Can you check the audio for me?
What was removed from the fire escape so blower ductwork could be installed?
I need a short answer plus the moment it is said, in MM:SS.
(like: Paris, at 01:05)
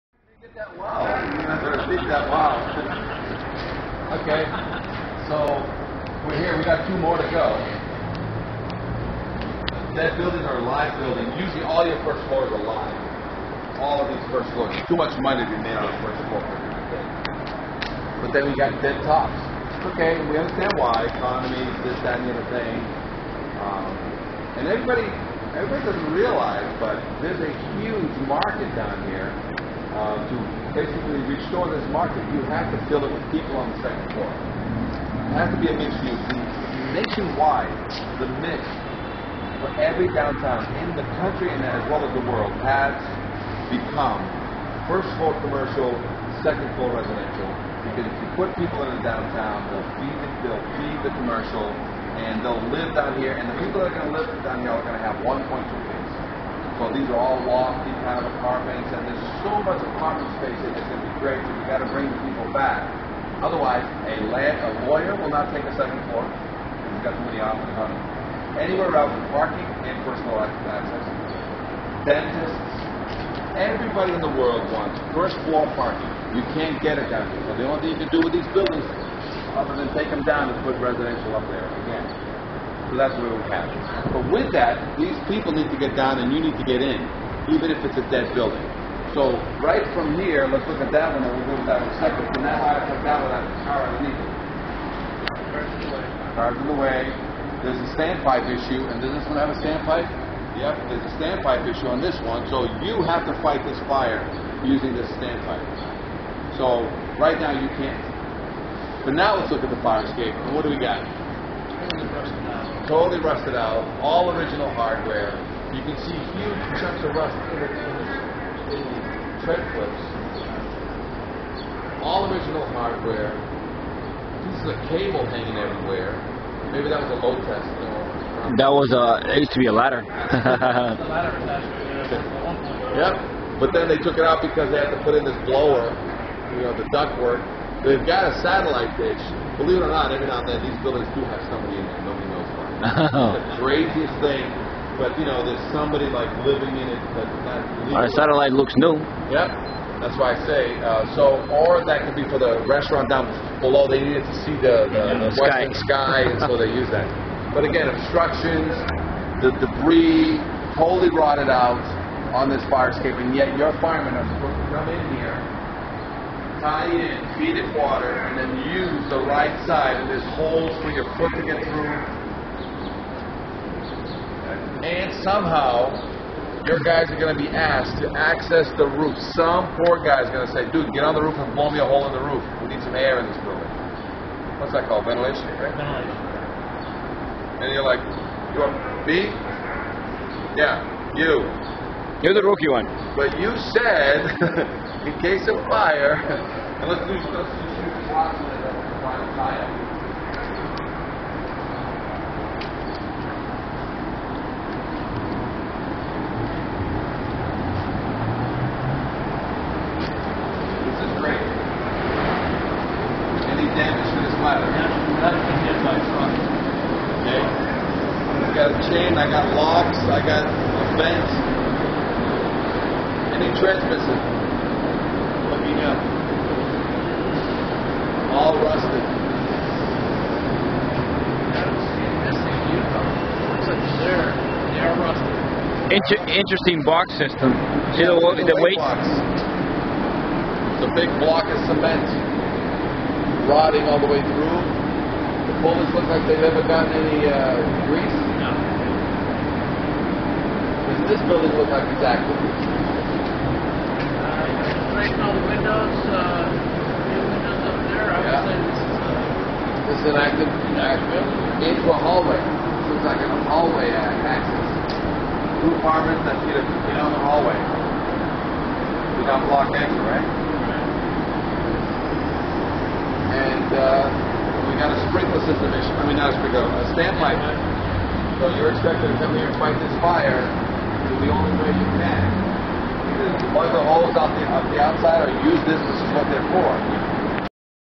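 A ladder, at 02:09.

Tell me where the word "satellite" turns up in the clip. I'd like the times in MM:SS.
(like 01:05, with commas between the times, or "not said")
02:18, 02:28.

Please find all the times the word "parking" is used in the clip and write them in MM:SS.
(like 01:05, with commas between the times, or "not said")
01:09, 01:15.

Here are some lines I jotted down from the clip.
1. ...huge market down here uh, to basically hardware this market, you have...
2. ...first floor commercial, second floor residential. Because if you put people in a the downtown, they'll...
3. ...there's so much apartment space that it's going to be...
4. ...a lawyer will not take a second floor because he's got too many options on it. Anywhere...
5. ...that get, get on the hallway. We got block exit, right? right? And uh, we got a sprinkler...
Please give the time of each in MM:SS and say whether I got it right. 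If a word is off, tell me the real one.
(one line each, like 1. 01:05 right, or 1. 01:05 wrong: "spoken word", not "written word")
1. 00:27 wrong: "restore", not "hardware"
2. 00:44 right
3. 00:59 right
4. 01:04 right
5. 04:26 right.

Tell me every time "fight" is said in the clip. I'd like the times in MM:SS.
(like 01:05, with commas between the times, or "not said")
01:43, 04:39.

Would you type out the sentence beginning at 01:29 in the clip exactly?
So right from here, let's look at that one and we'll go to that in a second.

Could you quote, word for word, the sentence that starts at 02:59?
Some poor guy is going to say, dude, get on the roof and blow me a hole in the roof.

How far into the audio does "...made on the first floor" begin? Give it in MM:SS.
00:15.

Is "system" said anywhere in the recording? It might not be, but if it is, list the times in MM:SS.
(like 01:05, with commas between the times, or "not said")
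03:57, 04:35.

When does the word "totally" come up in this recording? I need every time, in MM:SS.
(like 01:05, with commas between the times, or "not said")
01:52, 02:40.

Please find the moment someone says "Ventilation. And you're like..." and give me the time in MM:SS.
03:05.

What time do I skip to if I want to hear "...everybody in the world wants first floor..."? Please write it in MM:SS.
01:13.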